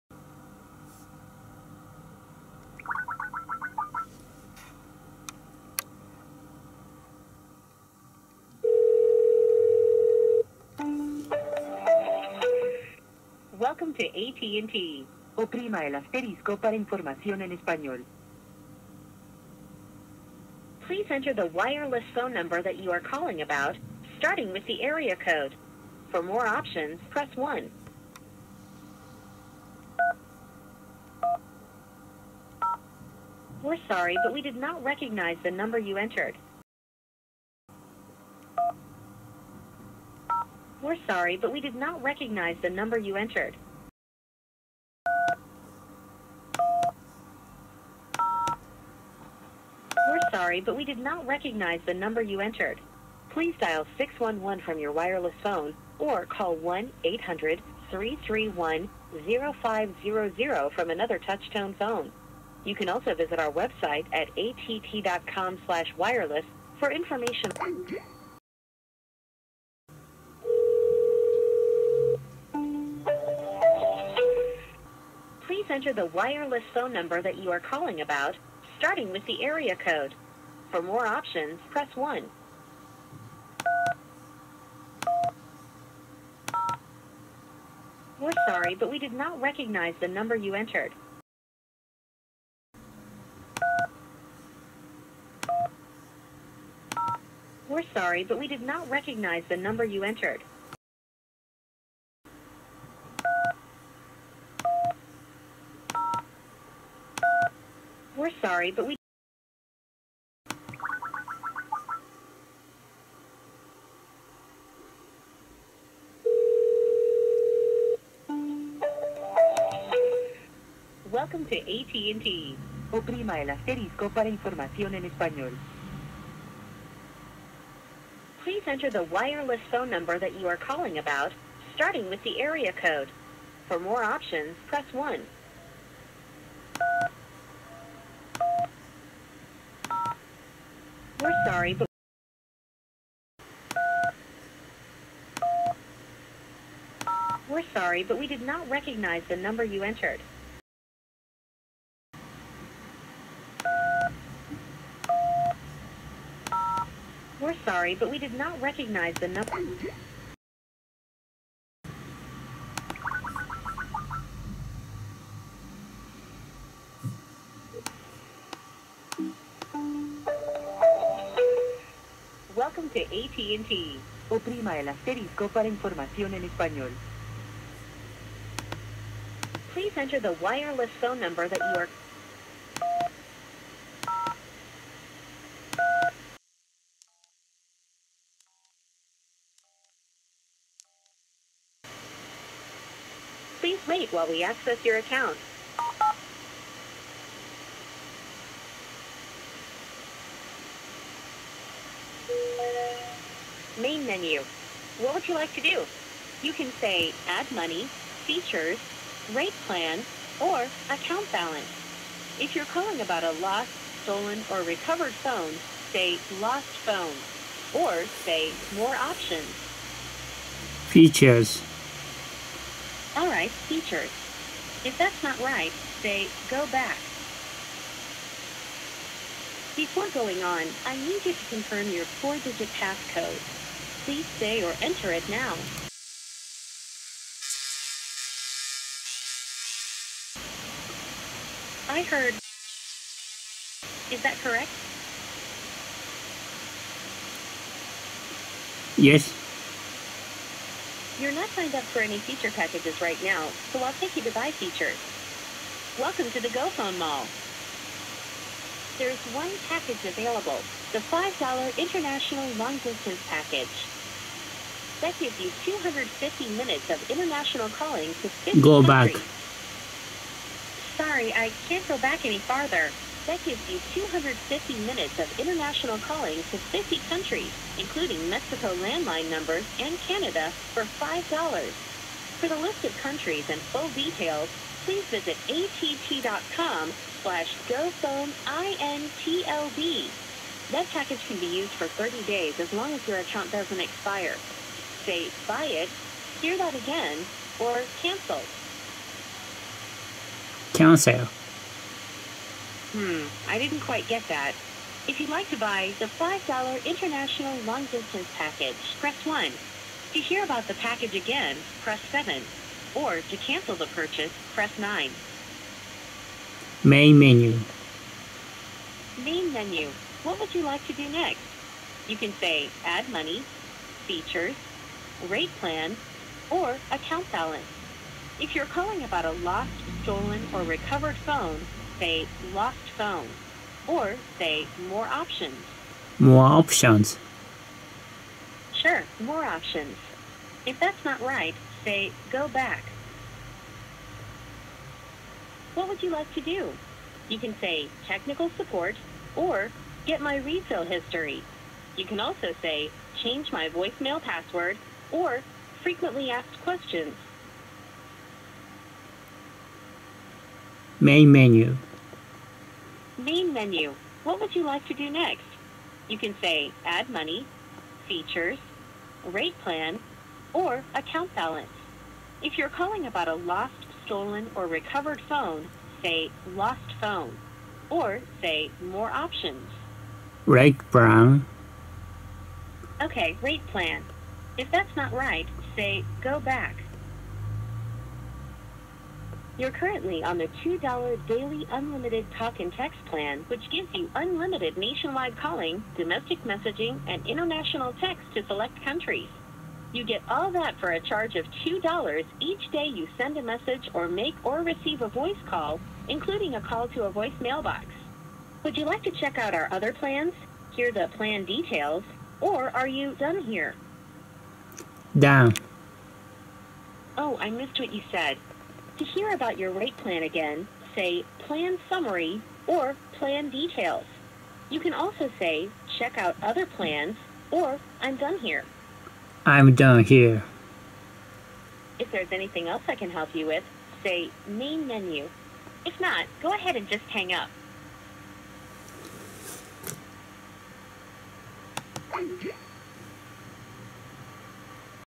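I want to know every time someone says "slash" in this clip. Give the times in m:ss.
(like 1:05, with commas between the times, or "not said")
1:05, 4:47.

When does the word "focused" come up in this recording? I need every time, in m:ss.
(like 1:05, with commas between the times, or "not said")
not said.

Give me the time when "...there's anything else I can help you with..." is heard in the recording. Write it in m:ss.
7:12.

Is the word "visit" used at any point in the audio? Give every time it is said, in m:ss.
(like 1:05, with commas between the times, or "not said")
1:03, 4:45.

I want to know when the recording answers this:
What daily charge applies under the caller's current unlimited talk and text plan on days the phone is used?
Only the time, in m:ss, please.
6:41.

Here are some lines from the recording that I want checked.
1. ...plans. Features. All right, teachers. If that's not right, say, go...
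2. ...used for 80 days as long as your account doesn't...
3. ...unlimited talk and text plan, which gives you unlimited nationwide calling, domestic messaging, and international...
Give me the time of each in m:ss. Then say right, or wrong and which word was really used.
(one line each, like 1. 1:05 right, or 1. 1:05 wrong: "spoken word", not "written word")
1. 3:38 wrong: "options", not "plans"
2. 4:51 wrong: "30", not "80"
3. 6:31 right.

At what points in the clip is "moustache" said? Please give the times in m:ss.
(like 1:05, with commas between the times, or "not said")
not said.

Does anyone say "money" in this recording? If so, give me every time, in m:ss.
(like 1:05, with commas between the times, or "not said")
3:27, 5:23, 6:07.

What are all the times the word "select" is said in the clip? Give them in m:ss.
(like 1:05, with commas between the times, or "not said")
6:38.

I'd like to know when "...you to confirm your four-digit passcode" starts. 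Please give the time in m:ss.
3:51.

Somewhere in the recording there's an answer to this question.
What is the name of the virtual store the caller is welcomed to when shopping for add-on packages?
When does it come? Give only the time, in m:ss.
4:16.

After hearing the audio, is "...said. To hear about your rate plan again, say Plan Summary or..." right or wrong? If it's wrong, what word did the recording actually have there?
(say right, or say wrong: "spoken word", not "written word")
right.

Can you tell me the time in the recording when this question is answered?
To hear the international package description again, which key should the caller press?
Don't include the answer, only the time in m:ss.
5:11.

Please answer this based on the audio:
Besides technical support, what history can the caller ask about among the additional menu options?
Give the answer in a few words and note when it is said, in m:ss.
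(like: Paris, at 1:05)
resale history, at 5:50.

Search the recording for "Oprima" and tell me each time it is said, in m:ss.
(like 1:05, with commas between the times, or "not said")
0:15, 2:02, 2:54.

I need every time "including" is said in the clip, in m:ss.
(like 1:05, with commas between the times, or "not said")
4:37, 6:46.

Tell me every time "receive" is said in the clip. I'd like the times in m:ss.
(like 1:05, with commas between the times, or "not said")
6:44.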